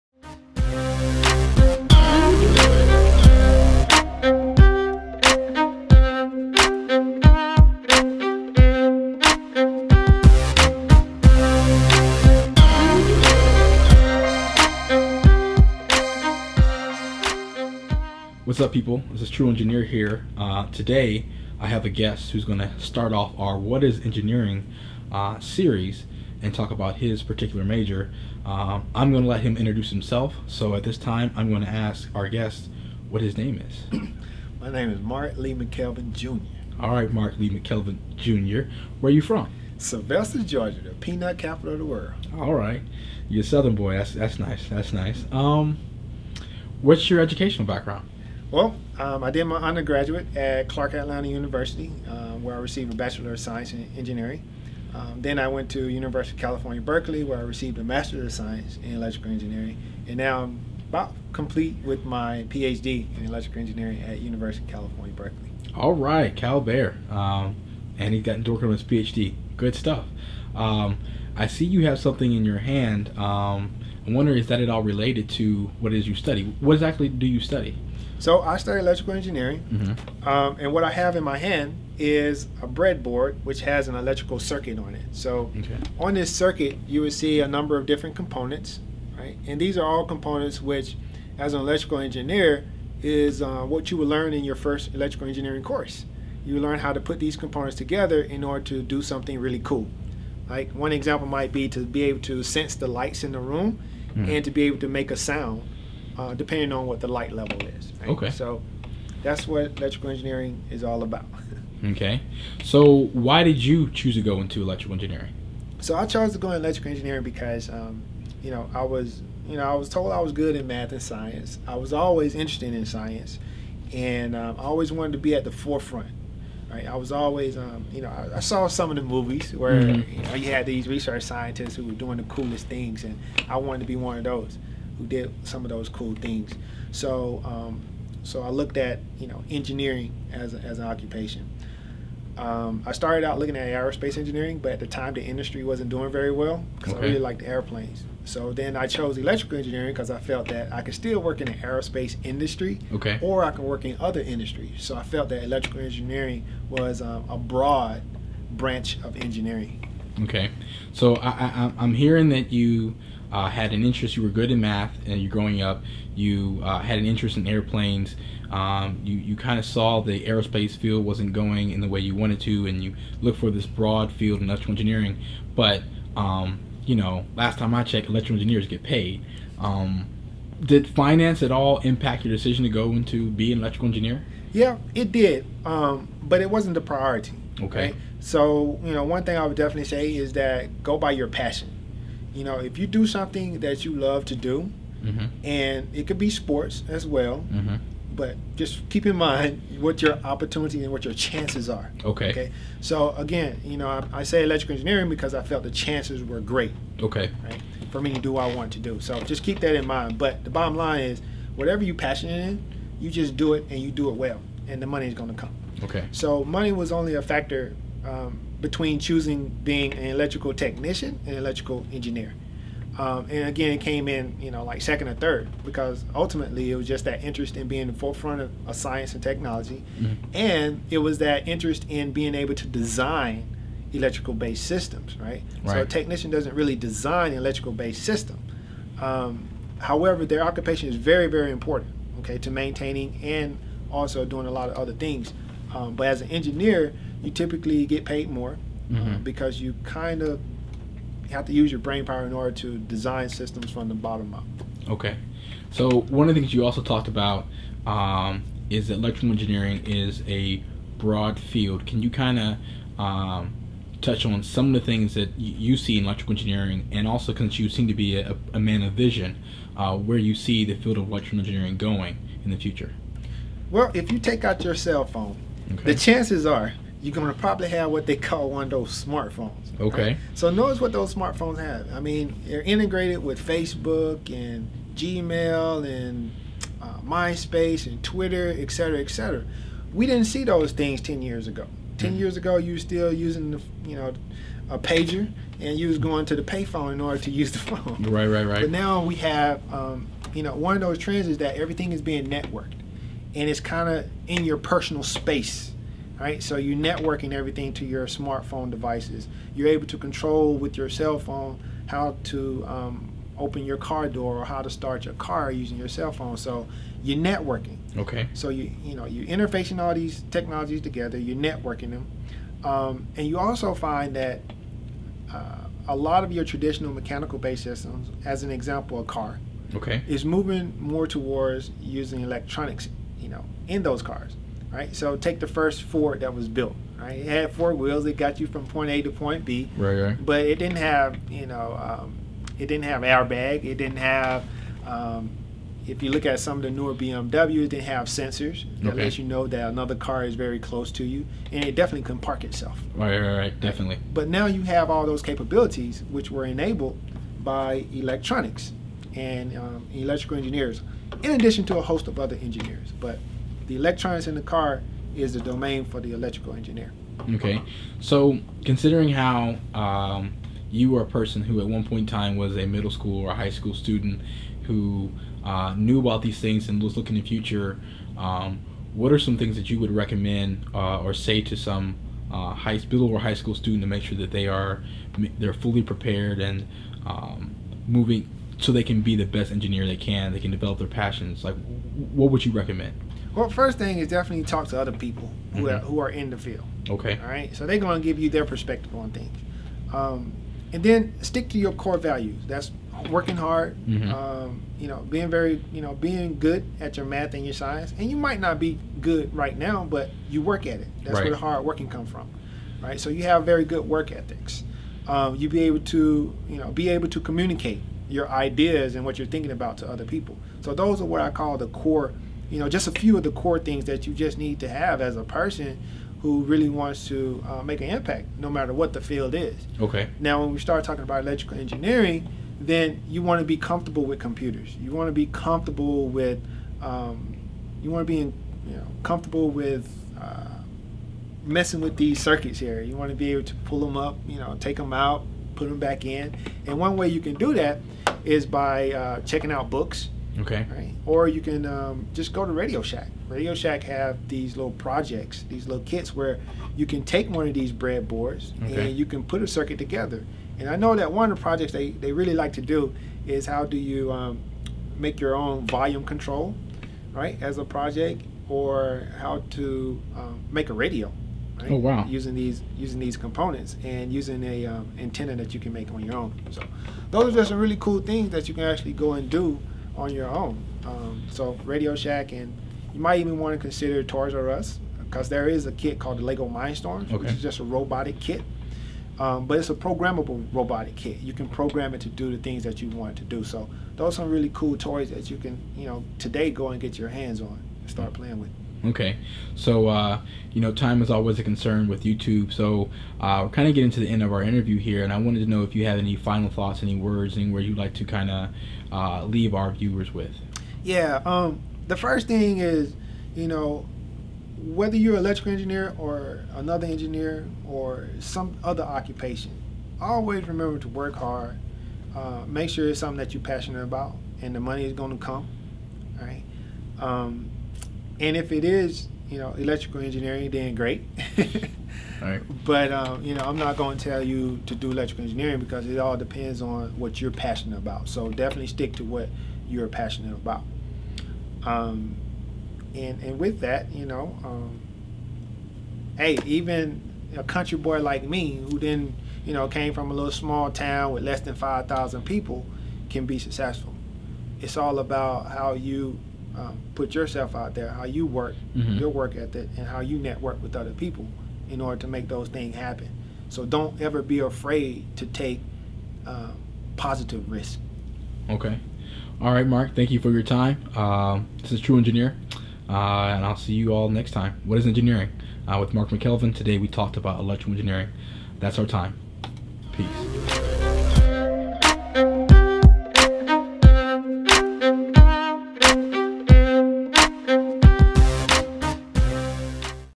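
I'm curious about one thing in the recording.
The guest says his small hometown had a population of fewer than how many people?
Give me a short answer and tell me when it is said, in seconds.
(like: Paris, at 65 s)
5,000, at 551 s.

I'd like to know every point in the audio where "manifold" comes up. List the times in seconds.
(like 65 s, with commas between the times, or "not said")
not said.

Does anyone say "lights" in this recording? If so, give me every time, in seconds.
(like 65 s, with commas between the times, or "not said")
102 s, 107 s.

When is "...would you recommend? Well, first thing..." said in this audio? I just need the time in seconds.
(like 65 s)
392 s.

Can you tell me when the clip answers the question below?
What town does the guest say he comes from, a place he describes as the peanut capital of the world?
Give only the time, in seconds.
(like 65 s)
39 s.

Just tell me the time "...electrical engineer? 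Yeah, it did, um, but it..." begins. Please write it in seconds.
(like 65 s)
183 s.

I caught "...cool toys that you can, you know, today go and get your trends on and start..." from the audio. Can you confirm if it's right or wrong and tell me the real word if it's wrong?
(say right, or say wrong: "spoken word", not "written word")
wrong: "hands", not "trends".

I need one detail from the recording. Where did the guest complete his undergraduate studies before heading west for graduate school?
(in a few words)
Clark Atlanta University.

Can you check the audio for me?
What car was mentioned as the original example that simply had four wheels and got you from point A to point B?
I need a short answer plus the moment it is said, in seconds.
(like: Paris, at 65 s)
the first Ford, at 335 s.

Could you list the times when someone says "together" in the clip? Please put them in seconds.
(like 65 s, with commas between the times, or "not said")
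97 s, 320 s, 459 s.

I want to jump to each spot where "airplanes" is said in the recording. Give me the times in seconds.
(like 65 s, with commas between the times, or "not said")
147 s, 167 s.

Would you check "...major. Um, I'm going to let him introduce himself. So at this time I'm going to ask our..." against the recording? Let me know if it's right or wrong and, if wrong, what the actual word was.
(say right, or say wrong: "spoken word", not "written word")
right.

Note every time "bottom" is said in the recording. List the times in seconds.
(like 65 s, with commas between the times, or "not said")
210 s, 253 s.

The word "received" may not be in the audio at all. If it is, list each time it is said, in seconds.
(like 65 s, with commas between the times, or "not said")
52 s, 57 s.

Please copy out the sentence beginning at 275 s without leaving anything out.
the chances are you're going to probably have what they call one of those smartphones.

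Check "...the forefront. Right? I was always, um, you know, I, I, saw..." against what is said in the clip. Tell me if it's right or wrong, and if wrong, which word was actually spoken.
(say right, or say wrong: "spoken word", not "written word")
right.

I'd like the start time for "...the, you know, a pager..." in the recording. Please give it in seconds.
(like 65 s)
293 s.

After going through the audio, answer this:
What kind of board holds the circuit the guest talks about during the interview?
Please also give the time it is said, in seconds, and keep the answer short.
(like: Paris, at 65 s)
breadboard, at 82 s.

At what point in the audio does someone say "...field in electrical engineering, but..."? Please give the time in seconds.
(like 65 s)
174 s.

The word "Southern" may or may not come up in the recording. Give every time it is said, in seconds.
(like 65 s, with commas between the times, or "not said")
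43 s.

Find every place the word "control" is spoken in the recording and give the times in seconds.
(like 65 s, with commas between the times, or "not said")
309 s, 466 s.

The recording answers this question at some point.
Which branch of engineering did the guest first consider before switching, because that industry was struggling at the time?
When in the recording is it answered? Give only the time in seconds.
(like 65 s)
143 s.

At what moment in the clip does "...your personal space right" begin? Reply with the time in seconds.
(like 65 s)
304 s.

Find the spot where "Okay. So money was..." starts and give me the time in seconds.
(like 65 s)
215 s.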